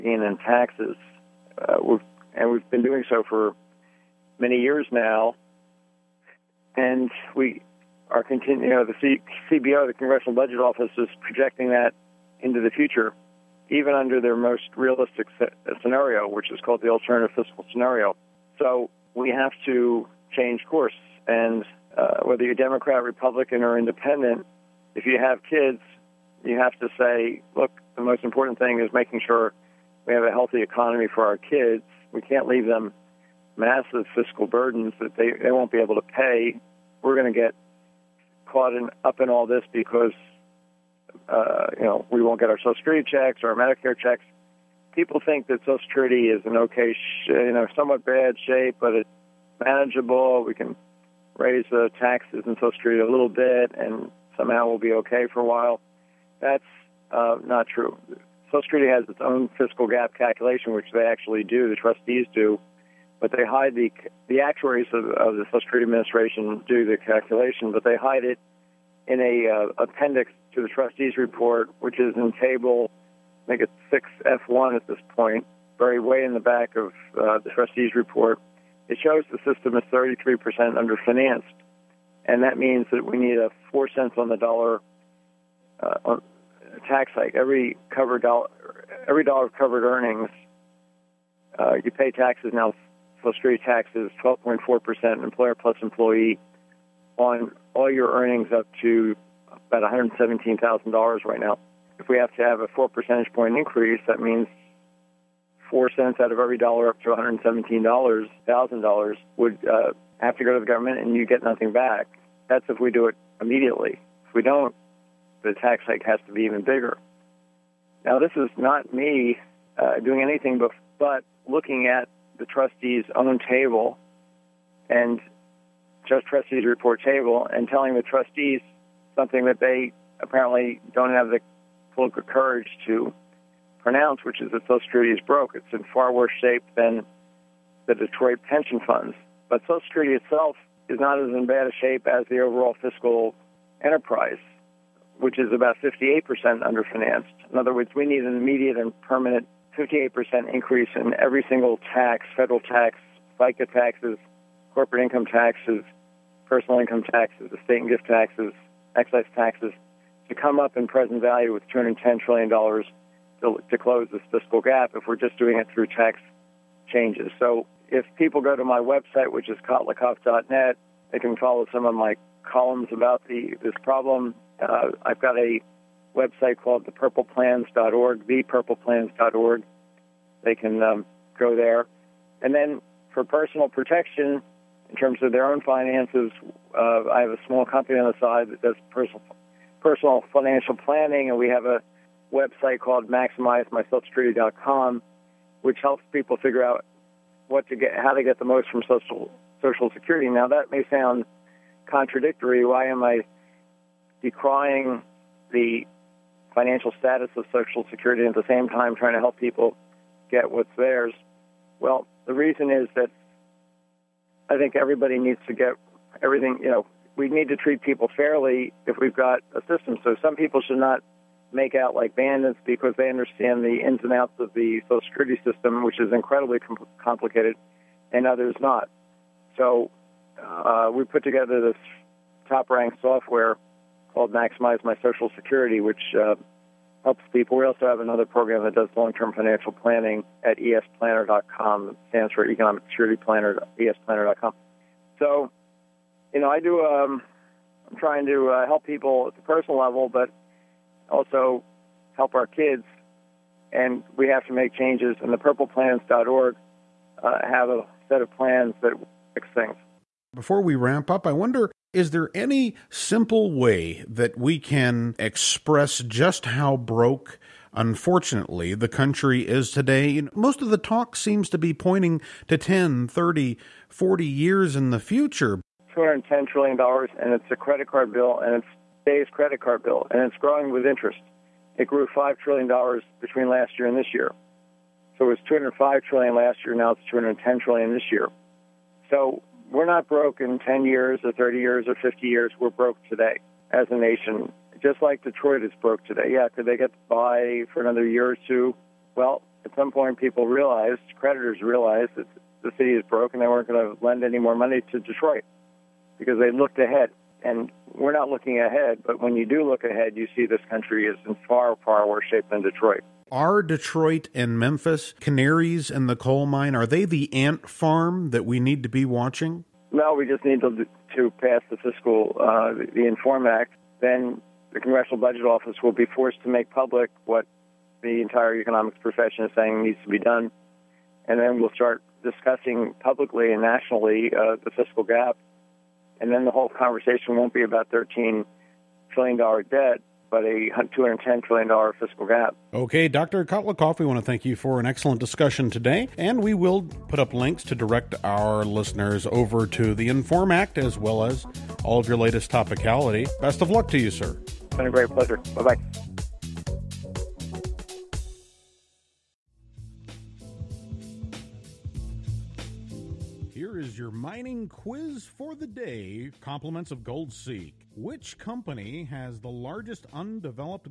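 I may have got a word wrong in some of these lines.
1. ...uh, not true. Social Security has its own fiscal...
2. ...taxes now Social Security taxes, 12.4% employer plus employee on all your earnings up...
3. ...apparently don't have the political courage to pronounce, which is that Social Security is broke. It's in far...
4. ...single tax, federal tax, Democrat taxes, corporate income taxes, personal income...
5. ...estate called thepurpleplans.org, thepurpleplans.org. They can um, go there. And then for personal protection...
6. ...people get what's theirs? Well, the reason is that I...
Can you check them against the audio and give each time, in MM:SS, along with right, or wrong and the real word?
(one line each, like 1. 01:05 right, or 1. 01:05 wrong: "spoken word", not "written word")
1. 00:57 right
2. 01:32 right
3. 02:10 right
4. 02:31 wrong: "FICA", not "Democrat"
5. 02:56 wrong: "website", not "estate"
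6. 03:29 right.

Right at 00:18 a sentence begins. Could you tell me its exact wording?
So we have to change course.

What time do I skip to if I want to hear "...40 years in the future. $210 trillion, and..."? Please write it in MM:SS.
04:33.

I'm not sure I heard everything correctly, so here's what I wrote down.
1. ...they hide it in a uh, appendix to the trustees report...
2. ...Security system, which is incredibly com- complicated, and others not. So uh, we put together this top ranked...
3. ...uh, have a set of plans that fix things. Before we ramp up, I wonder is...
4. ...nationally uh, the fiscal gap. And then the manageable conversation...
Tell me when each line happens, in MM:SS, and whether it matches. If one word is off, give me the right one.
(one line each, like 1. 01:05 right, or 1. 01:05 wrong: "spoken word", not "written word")
1. 01:07 right
2. 03:45 right
3. 04:17 right
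4. 05:33 wrong: "whole", not "manageable".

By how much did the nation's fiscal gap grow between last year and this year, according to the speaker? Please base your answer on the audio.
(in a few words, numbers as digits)
$5 trillion.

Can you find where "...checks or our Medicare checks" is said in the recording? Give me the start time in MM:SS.
00:43.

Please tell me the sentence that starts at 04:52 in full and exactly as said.
We're broke today as a nation, just like Detroit is broke today.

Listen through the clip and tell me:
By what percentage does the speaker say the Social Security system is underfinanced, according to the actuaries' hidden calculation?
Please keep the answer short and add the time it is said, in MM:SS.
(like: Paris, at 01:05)
33%, at 01:19.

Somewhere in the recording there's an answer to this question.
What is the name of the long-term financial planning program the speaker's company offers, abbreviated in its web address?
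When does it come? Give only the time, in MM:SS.
04:02.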